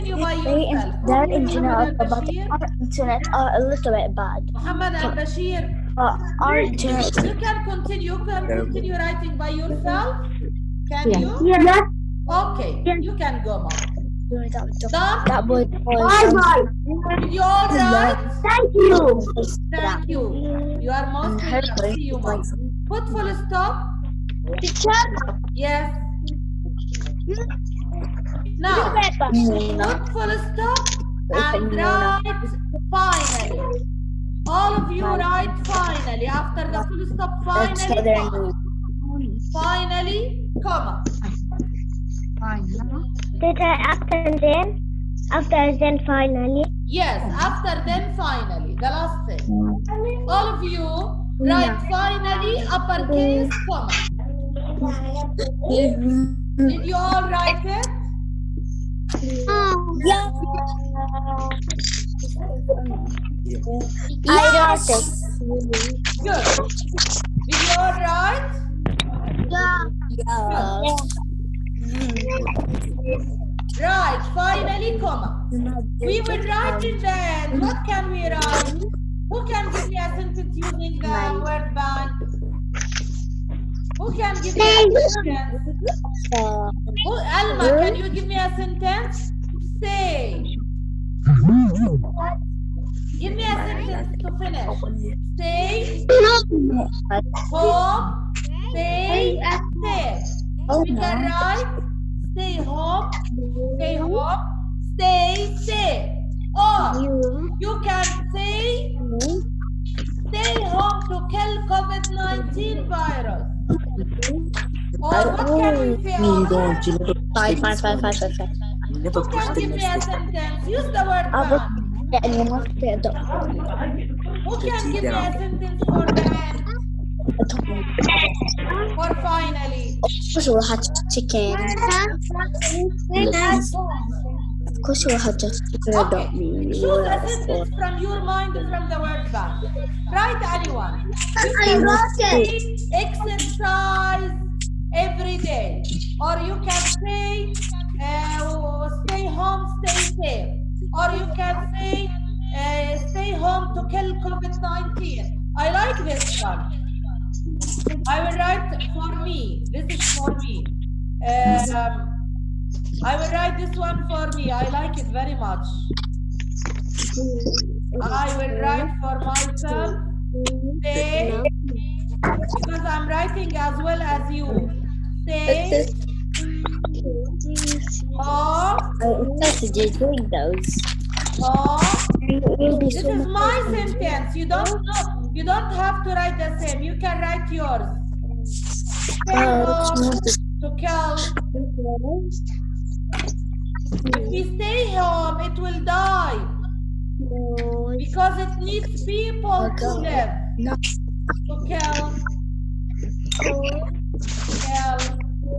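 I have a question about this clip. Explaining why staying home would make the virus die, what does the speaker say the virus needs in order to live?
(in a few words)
people.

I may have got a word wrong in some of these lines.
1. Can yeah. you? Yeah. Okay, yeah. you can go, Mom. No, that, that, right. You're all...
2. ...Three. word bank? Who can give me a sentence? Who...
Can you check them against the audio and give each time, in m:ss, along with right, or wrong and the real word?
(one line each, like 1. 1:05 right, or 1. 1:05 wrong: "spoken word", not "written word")
1. 0:10 right
2. 1:21 wrong: "Nine", not "Three".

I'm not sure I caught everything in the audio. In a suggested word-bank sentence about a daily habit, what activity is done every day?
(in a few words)
Exercise.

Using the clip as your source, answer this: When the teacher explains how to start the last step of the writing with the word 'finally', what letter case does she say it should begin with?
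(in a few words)
uppercase.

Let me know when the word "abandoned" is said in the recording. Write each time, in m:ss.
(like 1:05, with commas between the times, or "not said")
not said.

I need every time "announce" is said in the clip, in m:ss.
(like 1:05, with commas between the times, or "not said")
not said.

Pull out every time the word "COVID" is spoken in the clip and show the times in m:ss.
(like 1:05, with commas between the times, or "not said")
1:51, 2:34.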